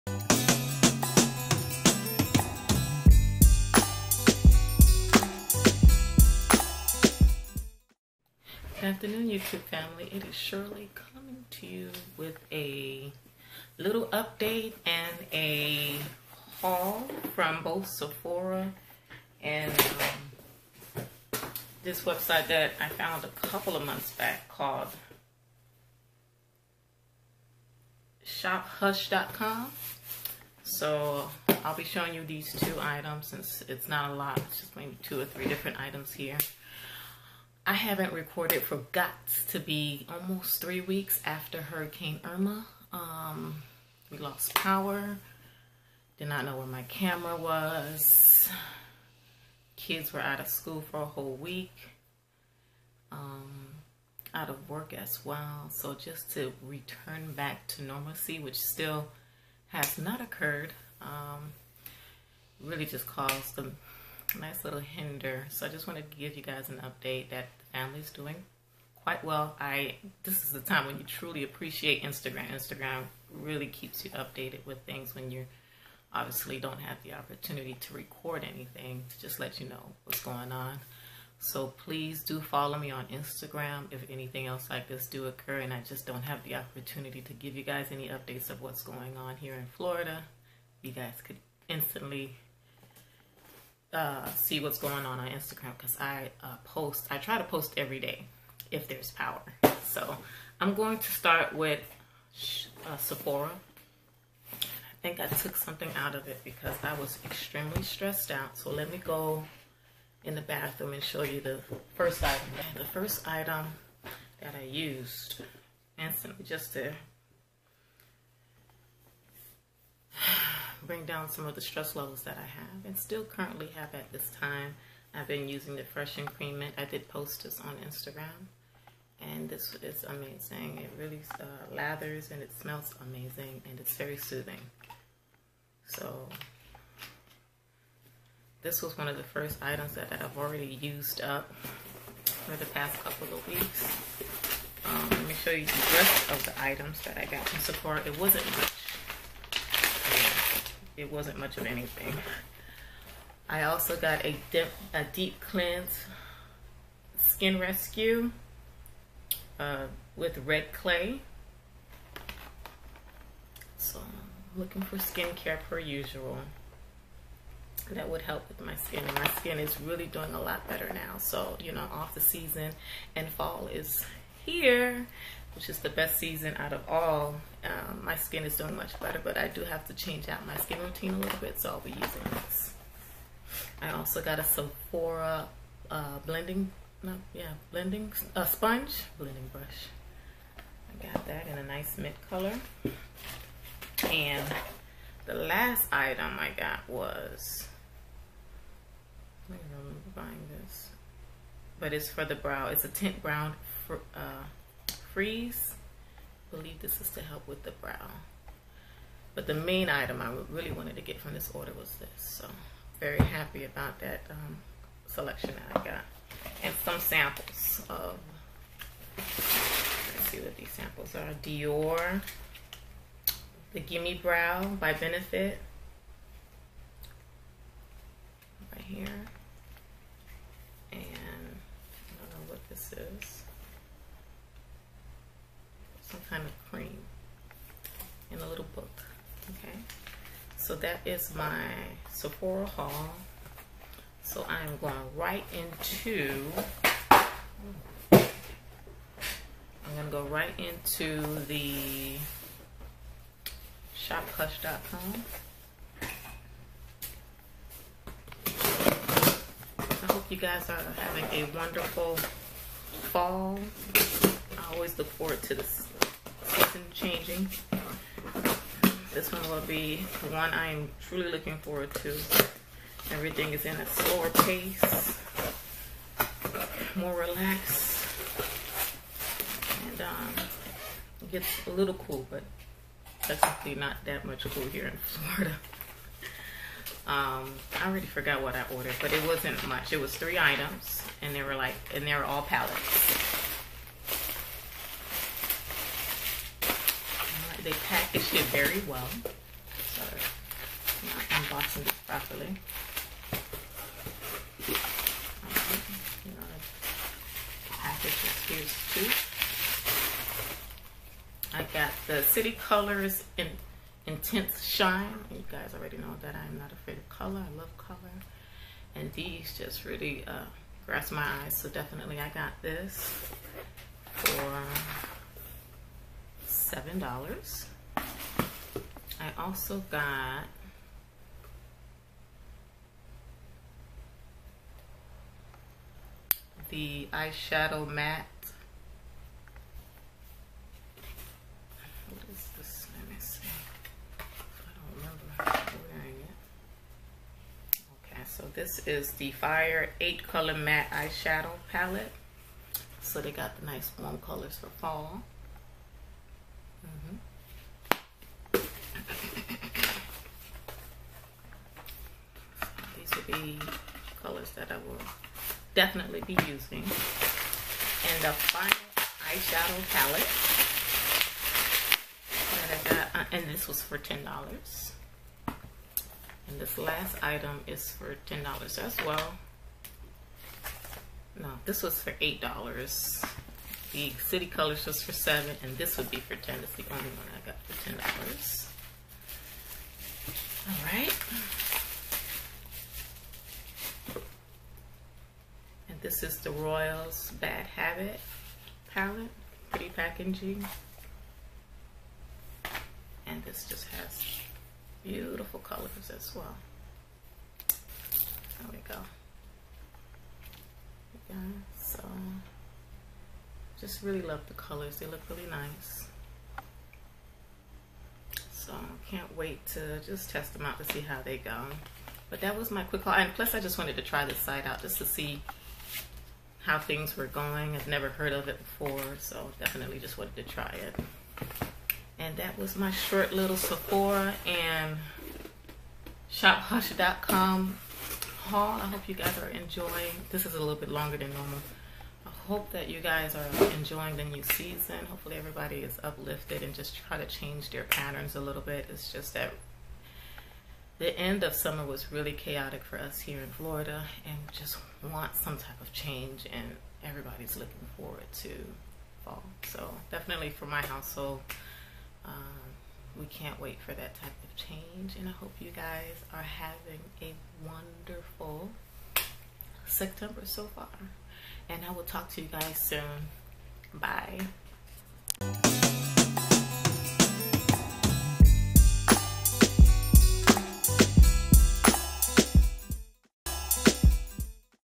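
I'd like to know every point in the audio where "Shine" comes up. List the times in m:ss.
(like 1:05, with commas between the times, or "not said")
5:14.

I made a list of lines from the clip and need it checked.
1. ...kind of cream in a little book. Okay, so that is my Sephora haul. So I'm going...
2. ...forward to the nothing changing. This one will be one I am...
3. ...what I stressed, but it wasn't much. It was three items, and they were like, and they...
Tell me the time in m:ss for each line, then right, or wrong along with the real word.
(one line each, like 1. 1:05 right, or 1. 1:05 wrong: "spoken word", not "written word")
1. 3:56 right
2. 4:25 right
3. 4:48 wrong: "ordered", not "stressed".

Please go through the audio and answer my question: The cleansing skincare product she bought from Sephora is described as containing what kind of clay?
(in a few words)
Red clay.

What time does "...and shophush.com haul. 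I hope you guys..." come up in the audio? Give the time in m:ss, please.
7:14.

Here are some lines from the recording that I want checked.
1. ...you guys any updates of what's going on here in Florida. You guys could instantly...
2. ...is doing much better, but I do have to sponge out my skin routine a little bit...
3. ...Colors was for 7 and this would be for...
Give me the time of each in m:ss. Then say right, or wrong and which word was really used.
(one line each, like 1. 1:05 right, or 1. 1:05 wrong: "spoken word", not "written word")
1. 1:27 right
2. 2:58 wrong: "change", not "sponge"
3. 6:24 right.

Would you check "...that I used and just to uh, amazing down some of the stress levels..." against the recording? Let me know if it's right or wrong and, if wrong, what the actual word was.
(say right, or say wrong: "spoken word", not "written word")
wrong: "bring", not "amazing".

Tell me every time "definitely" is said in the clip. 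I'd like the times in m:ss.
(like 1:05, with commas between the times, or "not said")
4:43, 5:21, 6:05, 7:09, 7:40.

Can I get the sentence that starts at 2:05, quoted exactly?
I've been using the Fresh and Cream Mint.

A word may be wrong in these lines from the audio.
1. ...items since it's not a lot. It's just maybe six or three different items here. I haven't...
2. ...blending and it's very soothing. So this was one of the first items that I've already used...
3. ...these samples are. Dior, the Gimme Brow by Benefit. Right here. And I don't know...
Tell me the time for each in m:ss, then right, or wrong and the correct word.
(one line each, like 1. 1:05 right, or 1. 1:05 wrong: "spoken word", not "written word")
1. 0:32 wrong: "two", not "six"
2. 2:13 wrong: "amazing", not "blending"
3. 3:40 right.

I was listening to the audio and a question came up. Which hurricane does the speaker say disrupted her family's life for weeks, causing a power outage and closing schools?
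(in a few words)
Irma.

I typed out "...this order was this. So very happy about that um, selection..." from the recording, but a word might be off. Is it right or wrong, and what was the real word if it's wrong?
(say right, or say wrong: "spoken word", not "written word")
right.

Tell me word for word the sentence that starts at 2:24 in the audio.
Um, let me show you the rest of the items that I got from Sephora.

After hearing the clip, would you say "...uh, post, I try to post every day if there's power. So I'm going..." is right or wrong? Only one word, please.
right.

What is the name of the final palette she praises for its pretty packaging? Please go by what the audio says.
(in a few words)
Royals Bad Habit.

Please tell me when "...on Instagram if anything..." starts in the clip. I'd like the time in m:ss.
1:22.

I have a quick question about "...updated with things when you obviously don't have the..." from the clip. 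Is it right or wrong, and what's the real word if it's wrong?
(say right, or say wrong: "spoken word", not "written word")
right.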